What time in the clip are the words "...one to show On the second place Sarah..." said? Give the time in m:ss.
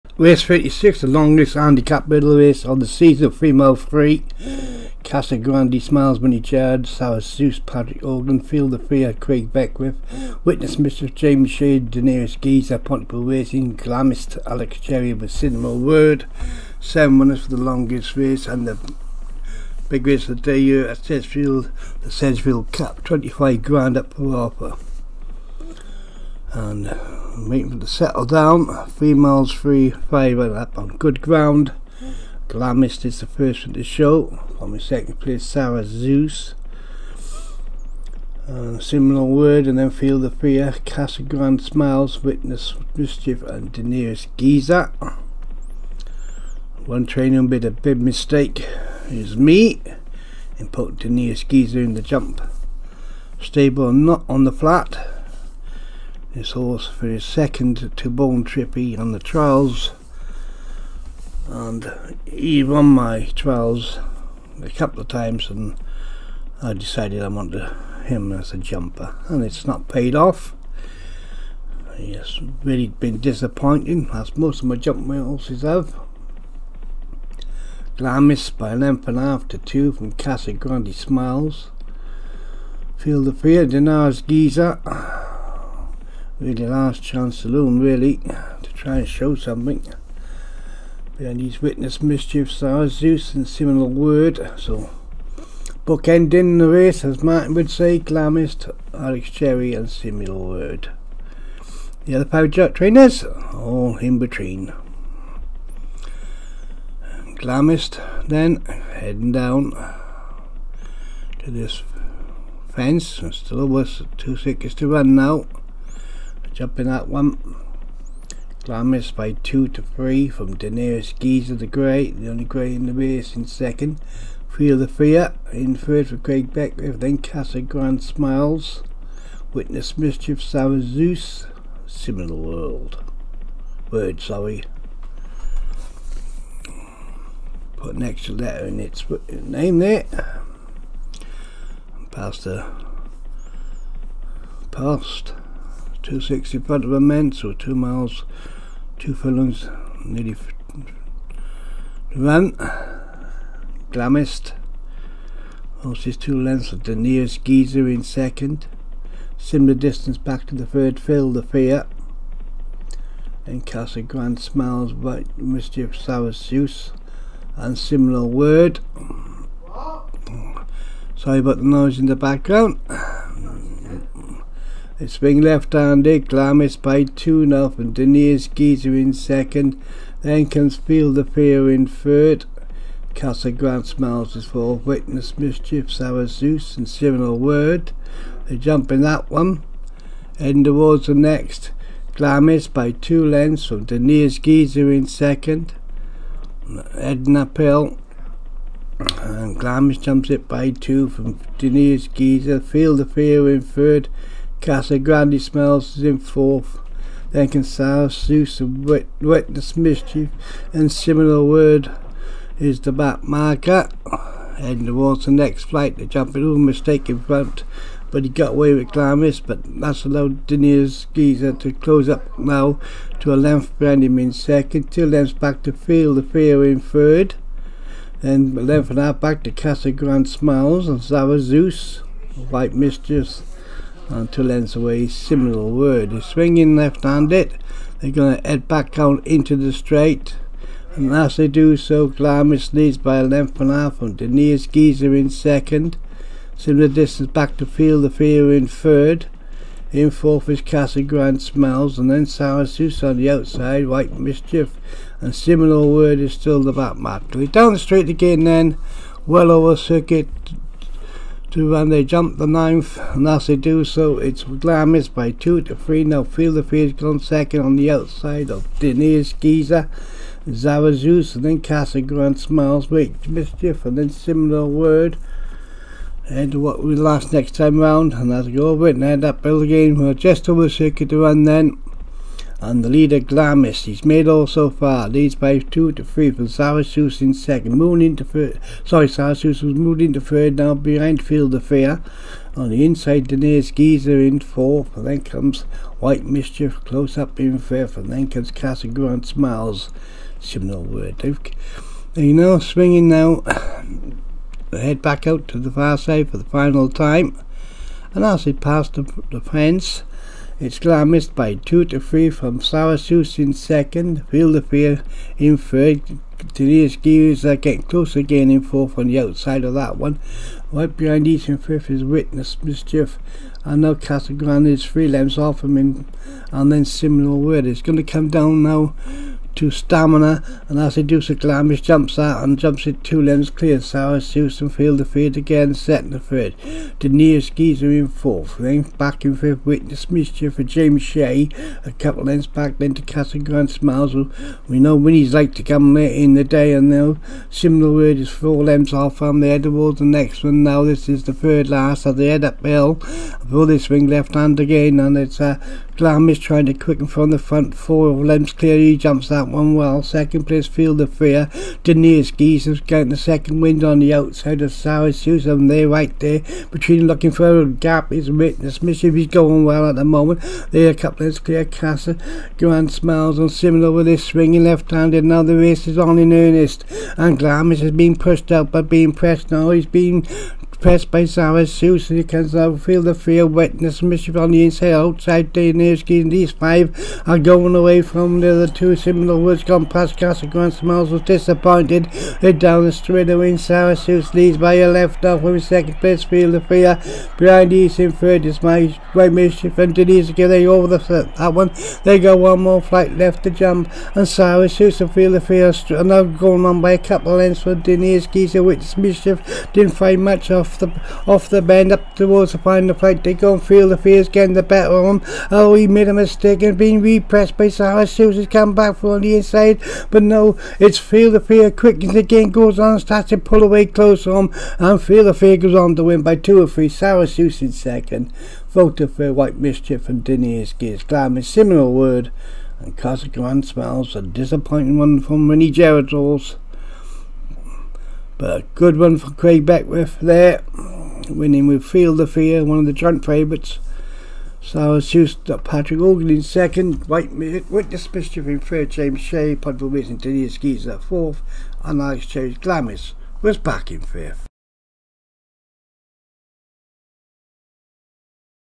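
0:33.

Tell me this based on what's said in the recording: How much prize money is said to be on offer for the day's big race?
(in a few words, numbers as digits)
25 grand.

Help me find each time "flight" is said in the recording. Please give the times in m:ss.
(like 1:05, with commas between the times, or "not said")
3:35, 6:42, 6:52.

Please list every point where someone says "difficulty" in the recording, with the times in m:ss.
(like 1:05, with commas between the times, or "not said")
not said.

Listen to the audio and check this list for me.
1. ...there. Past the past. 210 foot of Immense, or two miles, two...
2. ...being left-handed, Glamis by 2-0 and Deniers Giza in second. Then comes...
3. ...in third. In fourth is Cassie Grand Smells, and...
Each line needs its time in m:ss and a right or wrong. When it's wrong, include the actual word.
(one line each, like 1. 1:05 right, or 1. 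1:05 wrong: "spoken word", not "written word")
1. 2:19 wrong: "260", not "210"
2. 2:55 right
3. 4:08 right.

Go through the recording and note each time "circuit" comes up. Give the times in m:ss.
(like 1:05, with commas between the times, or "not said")
4:19, 4:40.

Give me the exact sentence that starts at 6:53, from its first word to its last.
They go and feel the fears getting the better of them.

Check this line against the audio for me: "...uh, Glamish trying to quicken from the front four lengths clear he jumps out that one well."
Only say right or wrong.
right.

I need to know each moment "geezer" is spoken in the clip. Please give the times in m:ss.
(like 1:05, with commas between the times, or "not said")
0:12, 2:01, 2:37, 3:41, 4:04, 4:53, 5:37, 6:48.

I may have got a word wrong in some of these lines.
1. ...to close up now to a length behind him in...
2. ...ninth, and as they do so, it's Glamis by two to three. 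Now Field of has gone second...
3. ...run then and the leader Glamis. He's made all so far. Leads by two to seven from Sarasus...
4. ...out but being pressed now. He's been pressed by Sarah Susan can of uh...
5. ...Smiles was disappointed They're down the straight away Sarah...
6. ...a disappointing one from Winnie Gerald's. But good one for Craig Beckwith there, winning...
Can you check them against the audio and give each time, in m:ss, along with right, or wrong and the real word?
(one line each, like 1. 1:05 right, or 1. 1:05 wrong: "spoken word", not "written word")
1. 3:41 right
2. 4:22 right
3. 4:41 wrong: "three", not "seven"
4. 6:18 right
5. 6:30 right
6. 7:14 right.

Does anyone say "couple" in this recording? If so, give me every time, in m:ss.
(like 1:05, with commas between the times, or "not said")
1:04, 5:41, 6:10, 6:46.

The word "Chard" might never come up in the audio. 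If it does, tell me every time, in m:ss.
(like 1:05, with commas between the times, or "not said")
0:06.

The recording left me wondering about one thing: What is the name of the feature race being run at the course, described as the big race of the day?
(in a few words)
Sedgefield Cup.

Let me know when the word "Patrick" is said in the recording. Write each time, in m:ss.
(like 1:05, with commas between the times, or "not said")
0:07, 7:25.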